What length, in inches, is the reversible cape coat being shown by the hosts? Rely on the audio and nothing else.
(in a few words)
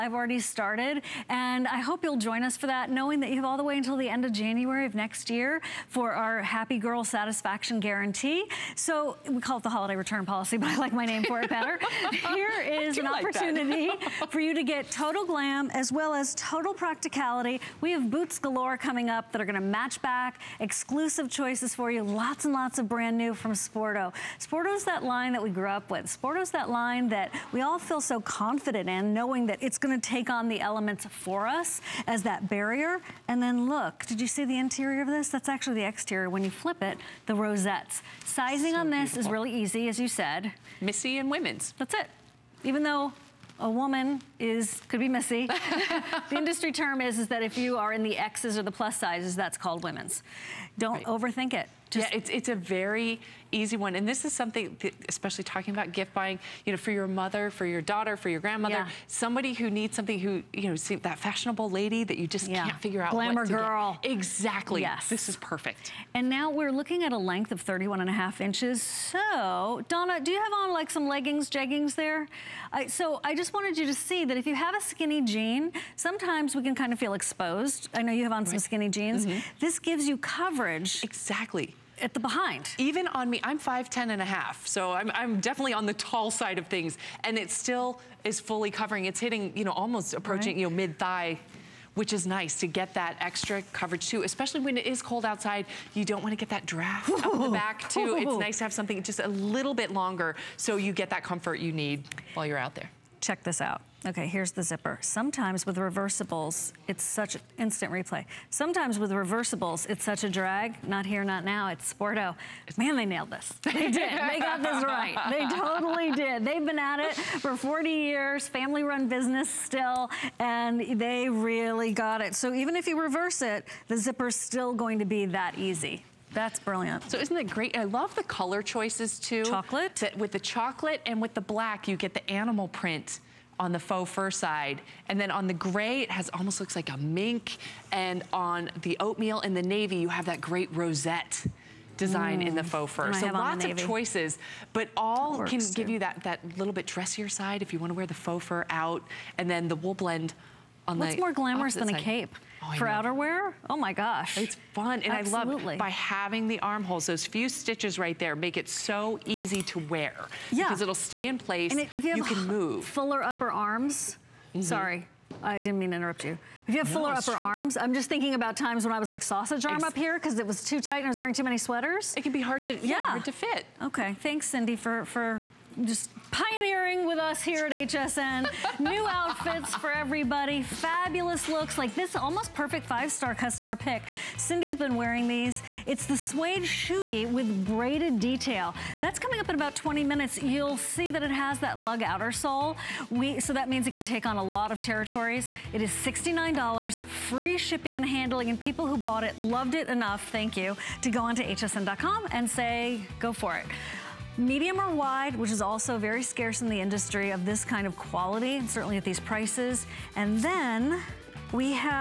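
31 and a half inches.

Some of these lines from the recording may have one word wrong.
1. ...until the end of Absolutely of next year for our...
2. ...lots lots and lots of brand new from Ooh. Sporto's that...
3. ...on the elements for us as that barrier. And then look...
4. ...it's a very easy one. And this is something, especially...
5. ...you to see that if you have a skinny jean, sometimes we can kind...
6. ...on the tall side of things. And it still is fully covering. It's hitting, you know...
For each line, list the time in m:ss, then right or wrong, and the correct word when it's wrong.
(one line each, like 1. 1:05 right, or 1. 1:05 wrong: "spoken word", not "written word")
1. 0:03 wrong: "January", not "Absolutely"
2. 0:22 wrong: "Sporto", not "Ooh"
3. 0:30 right
4. 0:52 right
5. 1:13 right
6. 1:25 right.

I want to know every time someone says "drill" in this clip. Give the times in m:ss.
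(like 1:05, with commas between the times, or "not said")
not said.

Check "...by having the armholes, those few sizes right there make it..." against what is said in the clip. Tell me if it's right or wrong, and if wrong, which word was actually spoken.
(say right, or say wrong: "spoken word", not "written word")
wrong: "stitches", not "sizes".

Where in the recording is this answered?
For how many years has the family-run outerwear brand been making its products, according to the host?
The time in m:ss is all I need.
1:57.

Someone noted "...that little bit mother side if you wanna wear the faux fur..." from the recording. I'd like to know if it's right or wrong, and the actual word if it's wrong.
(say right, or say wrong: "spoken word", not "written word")
wrong: "dressier", not "mother".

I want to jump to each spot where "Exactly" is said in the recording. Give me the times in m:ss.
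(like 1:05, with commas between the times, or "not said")
1:04, 1:21.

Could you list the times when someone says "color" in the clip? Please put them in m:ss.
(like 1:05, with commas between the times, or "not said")
2:08.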